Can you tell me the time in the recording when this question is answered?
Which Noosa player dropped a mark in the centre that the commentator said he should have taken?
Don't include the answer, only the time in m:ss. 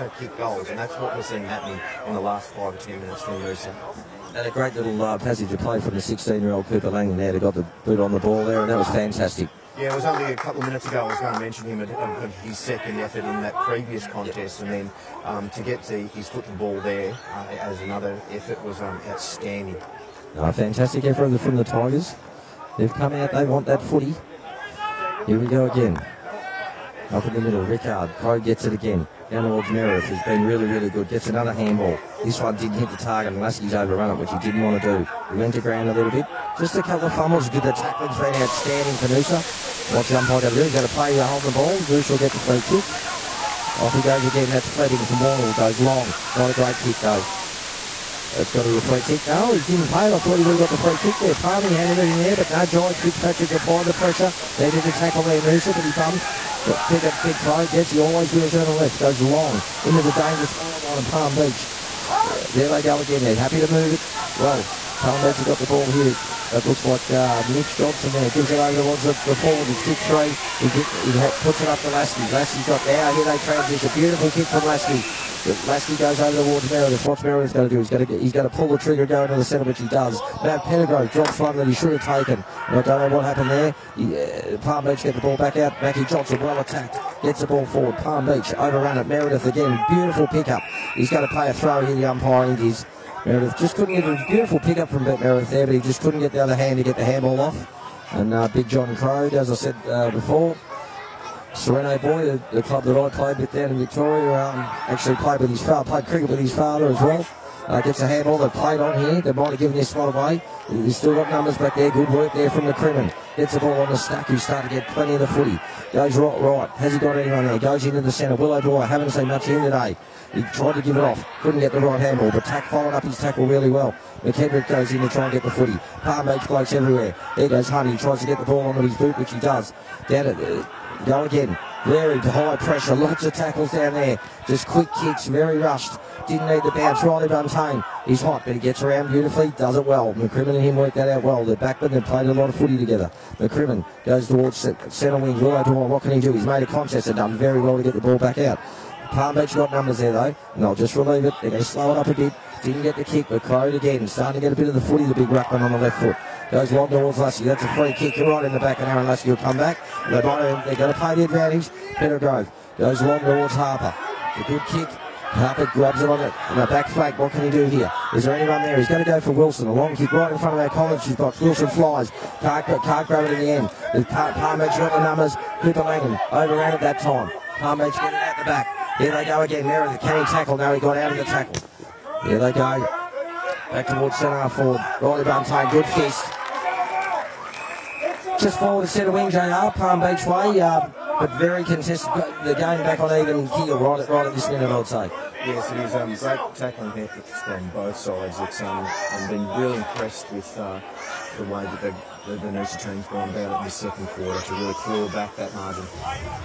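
1:20.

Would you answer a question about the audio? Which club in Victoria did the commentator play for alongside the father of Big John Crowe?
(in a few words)
Sereno.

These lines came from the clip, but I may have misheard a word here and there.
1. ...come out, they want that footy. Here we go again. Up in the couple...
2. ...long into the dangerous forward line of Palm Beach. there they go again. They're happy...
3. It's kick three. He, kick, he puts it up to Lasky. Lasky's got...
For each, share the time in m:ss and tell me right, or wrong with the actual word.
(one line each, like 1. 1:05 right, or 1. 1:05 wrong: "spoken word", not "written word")
1. 0:22 wrong: "middle", not "couple"
2. 0:59 right
3. 1:09 right.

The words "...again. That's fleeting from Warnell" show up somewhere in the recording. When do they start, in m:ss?
0:44.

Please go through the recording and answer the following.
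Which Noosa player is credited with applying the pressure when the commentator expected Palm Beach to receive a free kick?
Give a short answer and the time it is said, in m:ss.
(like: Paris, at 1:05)
Jai Fitzpatrick, at 0:52.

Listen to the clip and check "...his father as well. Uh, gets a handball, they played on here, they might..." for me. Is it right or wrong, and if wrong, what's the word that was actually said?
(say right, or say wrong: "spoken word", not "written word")
right.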